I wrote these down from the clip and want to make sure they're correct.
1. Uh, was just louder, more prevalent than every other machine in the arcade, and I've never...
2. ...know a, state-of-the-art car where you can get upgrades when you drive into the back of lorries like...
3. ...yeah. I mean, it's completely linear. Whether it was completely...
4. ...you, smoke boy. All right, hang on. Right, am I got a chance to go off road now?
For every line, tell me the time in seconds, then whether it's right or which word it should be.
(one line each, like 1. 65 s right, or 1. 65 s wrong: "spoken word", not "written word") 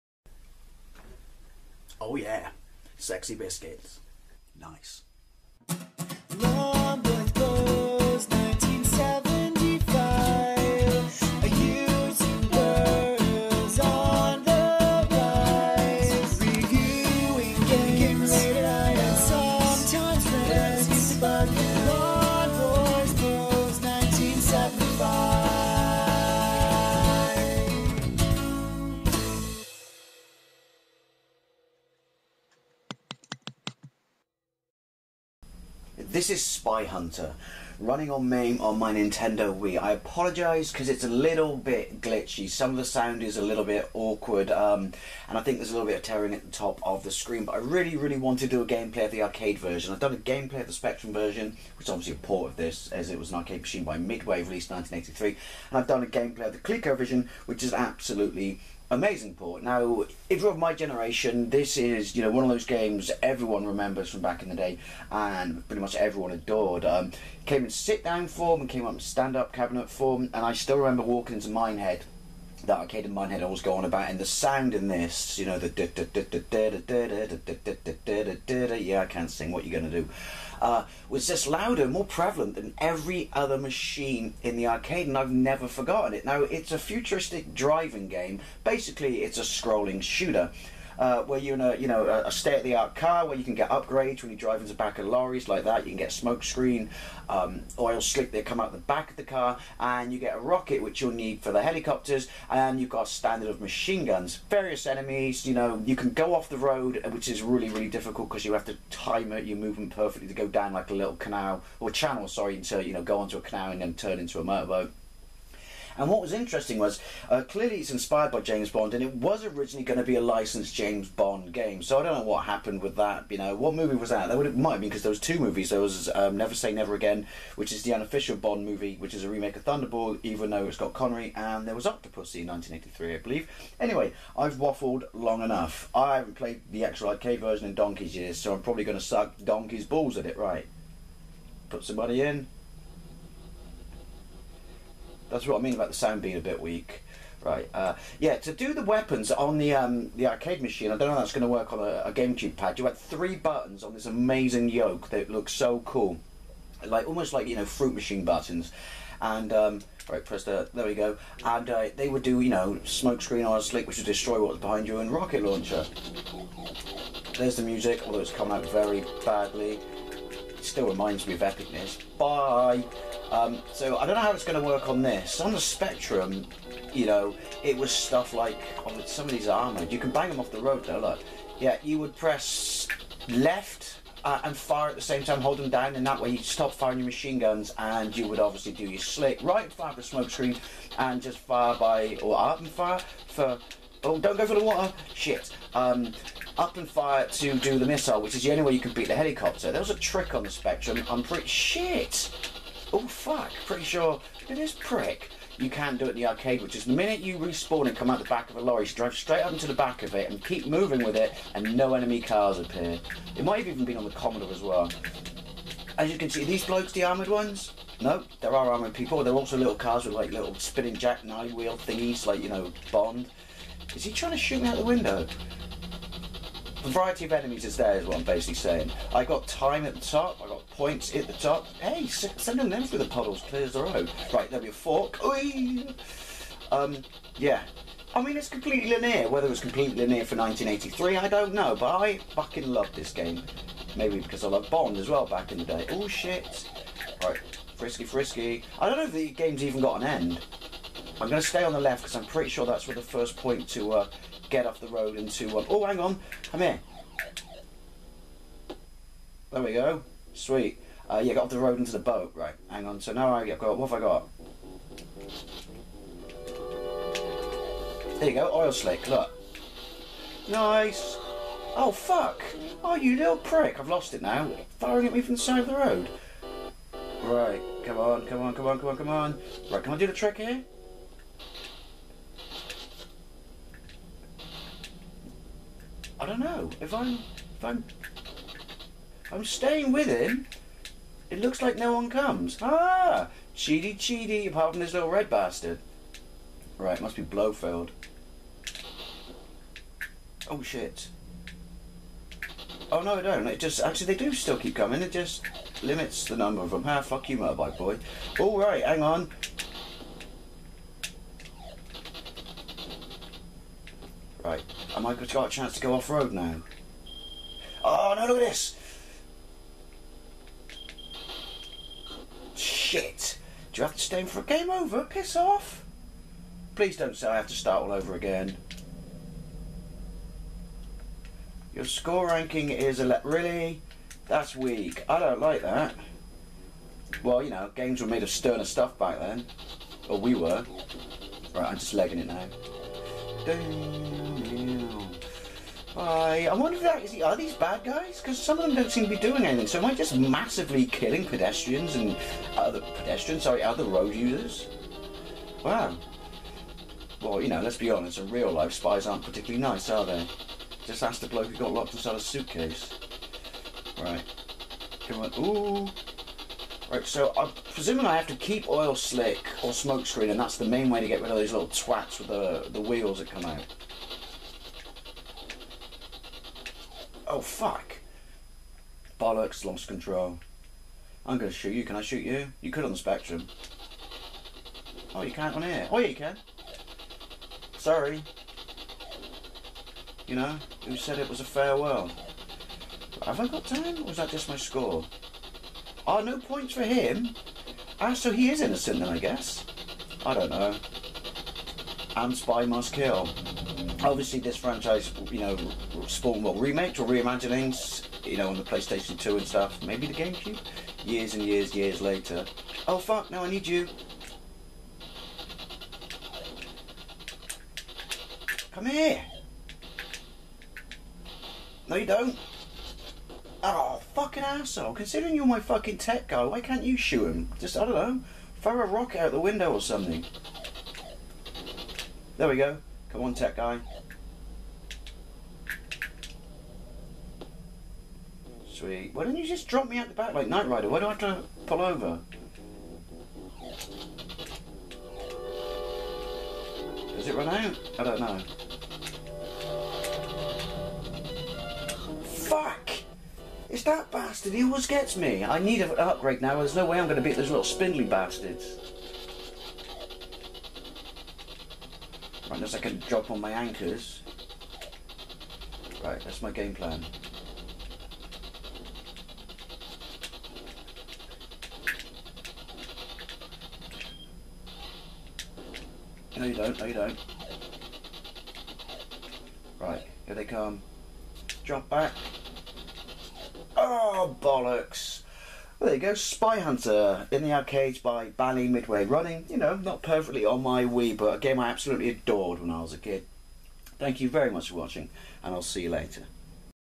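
1. 80 s right
2. 91 s right
3. 237 s right
4. 307 s wrong: "motorbike", not "smoke".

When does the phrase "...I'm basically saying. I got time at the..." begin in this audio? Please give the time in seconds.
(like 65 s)
228 s.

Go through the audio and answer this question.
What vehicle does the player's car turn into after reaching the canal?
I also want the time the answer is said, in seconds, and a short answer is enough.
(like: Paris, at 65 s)
motorboat, at 114 s.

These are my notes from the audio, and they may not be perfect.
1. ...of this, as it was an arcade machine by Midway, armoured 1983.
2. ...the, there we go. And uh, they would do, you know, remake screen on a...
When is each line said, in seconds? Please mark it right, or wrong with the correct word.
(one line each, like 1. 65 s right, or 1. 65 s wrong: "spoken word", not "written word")
1. 52 s wrong: "released", not "armoured"
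2. 160 s wrong: "smoke", not "remake".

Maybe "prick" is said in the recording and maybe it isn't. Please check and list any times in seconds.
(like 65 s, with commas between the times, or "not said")
204 s, 273 s.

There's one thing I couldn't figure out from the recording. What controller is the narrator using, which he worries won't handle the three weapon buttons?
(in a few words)
GameCube pad.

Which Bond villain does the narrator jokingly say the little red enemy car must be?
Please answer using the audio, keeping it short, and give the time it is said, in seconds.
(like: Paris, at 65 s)
Blofeld, at 297 s.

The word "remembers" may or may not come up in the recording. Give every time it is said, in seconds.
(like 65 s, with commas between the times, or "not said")
63 s, 70 s.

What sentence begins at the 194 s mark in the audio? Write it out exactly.
Oh, don't go for the water.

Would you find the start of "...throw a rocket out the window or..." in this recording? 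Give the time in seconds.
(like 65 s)
428 s.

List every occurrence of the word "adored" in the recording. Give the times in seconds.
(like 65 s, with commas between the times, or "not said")
66 s, 492 s.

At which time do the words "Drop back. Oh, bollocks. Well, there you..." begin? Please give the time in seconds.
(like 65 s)
481 s.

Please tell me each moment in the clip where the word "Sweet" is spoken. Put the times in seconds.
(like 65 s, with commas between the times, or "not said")
260 s, 438 s.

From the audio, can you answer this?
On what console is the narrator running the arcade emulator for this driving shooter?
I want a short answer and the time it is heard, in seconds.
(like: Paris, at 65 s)
Nintendo Wii, at 38 s.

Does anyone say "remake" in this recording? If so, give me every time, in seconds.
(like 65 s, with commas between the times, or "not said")
129 s, 406 s.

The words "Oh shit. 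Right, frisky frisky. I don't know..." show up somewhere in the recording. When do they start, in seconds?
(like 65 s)
245 s.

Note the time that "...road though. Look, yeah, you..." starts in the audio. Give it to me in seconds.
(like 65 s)
180 s.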